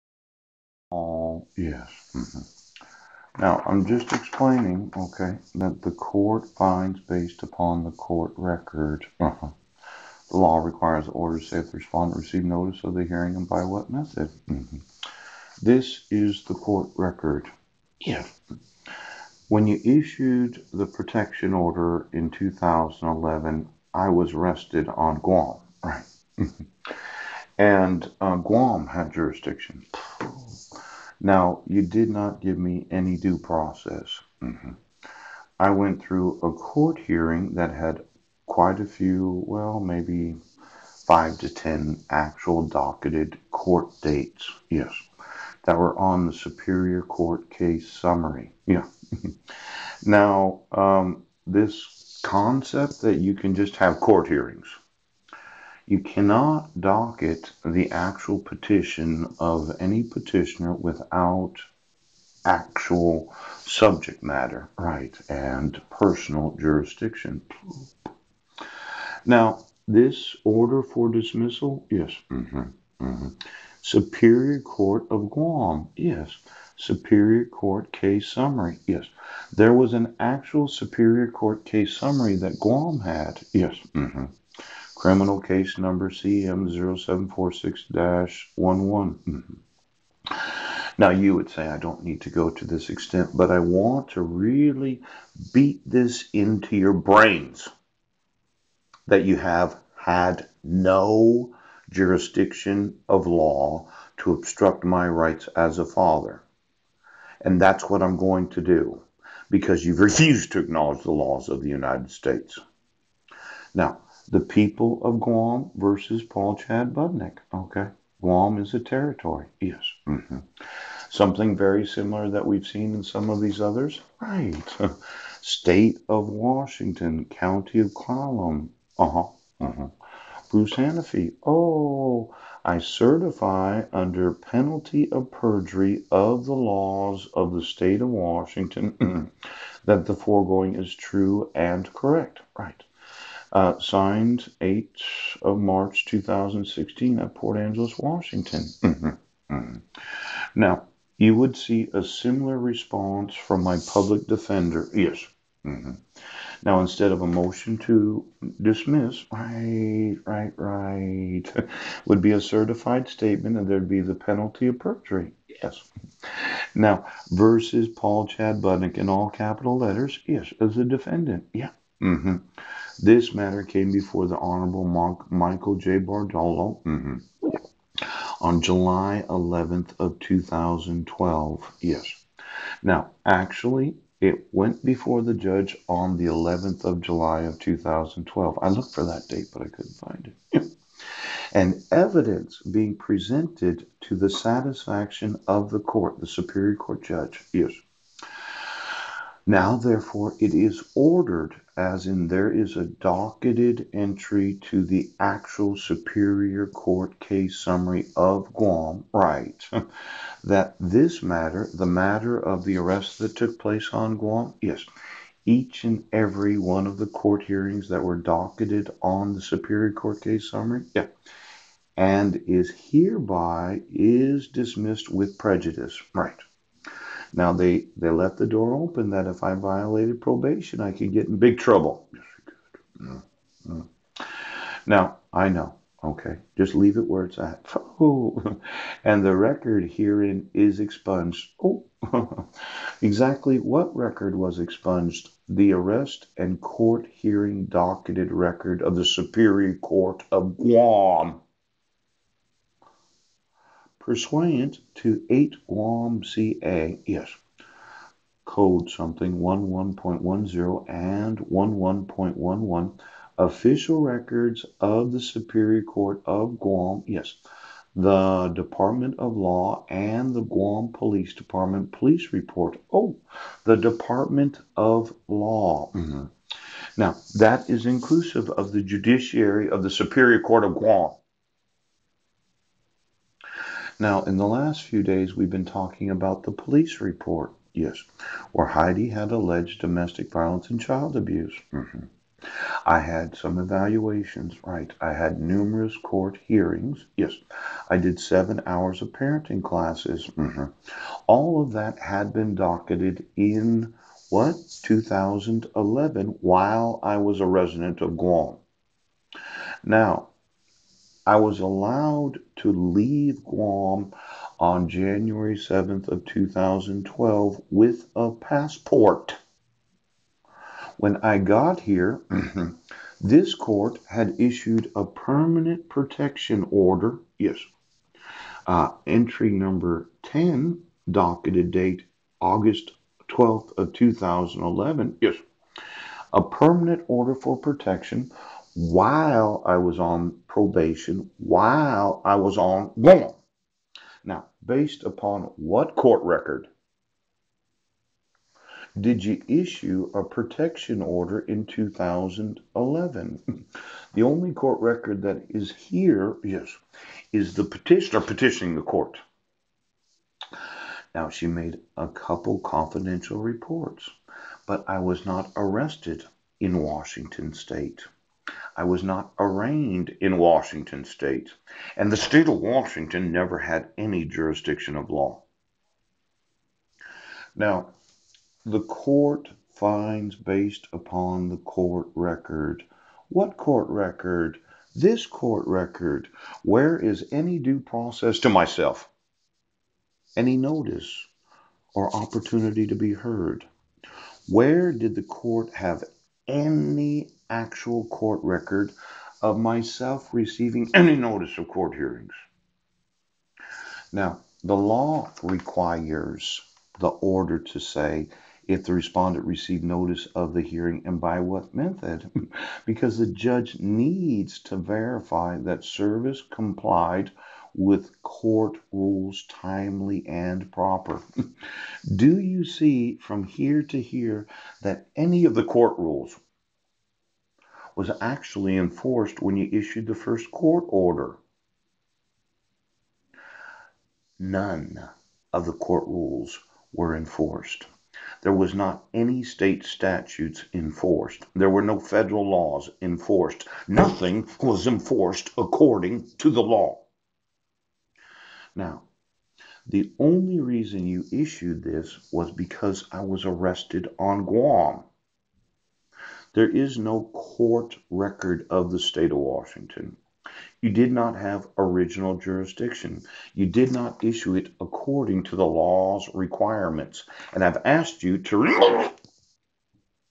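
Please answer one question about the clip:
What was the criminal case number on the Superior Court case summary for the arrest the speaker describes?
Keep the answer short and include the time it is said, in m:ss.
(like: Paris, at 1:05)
CM0746-11, at 1:26.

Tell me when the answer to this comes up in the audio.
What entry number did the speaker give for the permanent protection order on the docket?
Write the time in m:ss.
5:29.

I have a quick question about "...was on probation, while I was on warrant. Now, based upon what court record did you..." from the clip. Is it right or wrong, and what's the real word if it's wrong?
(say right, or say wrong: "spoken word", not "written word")
right.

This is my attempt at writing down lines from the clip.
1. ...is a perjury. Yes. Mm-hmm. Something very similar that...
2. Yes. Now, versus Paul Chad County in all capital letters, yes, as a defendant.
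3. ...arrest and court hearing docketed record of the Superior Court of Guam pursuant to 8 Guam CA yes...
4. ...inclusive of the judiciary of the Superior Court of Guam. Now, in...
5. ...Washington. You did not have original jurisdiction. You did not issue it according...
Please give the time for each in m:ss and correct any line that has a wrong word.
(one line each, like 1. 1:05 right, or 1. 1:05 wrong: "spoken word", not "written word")
1. 1:58 wrong: "territory", not "perjury"
2. 2:45 wrong: "Budnek", not "County"
3. 4:05 right
4. 4:37 right
5. 7:39 right.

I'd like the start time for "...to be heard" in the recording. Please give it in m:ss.
6:32.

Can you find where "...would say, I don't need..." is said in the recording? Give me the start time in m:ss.
1:31.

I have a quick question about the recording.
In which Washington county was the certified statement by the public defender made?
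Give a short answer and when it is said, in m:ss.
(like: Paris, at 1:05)
Clallam, at 2:07.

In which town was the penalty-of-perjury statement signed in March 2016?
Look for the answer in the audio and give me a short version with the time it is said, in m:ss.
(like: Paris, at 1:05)
Port Angeles, at 2:27.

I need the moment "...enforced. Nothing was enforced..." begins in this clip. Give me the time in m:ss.
7:23.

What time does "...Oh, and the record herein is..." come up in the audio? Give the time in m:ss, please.
3:58.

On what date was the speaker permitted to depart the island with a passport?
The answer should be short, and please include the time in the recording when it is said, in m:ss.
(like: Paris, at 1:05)
January 7th, 2012, at 5:14.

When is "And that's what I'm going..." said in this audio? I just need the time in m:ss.
1:47.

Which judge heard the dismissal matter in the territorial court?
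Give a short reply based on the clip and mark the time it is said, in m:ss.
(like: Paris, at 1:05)
Michael J. Bordallo, at 2:55.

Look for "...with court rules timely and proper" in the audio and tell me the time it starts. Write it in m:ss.
6:57.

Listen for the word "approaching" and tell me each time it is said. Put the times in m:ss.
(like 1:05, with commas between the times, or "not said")
not said.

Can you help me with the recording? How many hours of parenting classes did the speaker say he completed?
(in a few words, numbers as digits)
7.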